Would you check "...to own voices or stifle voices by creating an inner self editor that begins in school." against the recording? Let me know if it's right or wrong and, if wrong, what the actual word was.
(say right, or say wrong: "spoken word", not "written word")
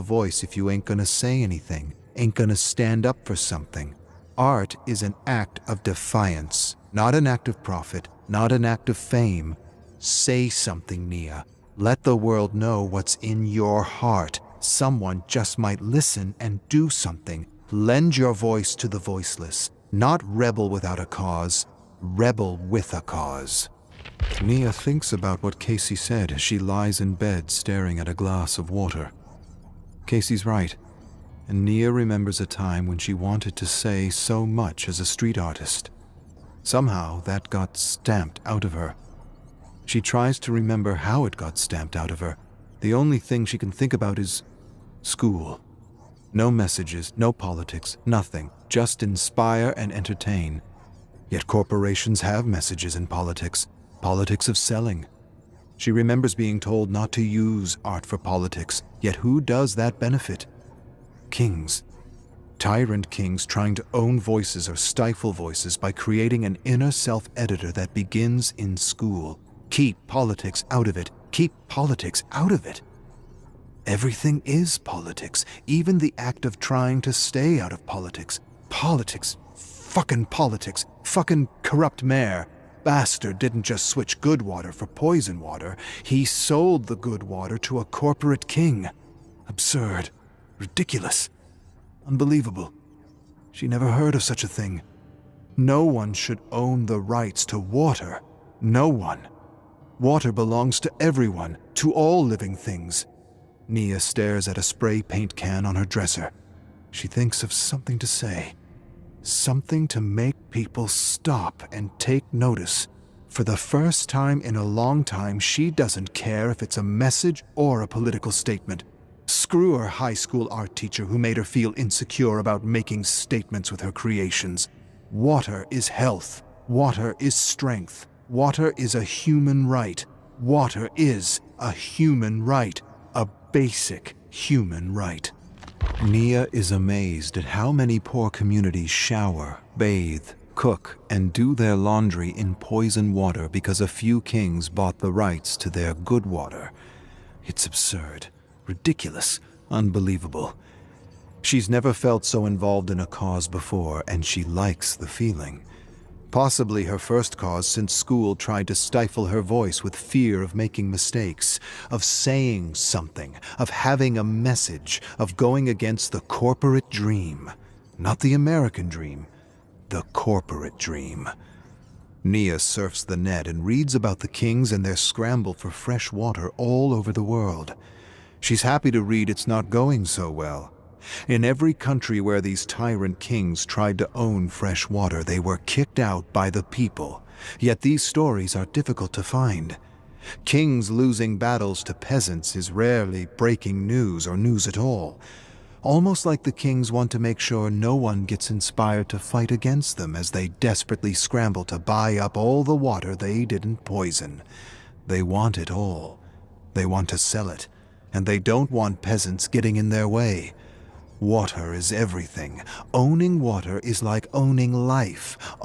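right.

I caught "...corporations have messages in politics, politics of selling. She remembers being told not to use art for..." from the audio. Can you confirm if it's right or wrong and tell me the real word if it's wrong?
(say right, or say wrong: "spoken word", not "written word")
right.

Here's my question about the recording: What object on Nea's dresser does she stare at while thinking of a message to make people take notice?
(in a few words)
A spray paint can.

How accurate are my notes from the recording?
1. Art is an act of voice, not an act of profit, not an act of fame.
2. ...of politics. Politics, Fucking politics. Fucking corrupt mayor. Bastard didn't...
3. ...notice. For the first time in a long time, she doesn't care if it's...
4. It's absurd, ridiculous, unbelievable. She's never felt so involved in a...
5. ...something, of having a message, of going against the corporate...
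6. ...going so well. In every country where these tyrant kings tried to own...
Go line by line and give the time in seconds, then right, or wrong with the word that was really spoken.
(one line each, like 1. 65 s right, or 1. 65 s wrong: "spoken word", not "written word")
1. 4 s wrong: "defiance", not "voice"
2. 77 s right
3. 112 s right
4. 147 s right
5. 162 s right
6. 179 s right.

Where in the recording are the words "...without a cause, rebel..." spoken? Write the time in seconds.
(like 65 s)
20 s.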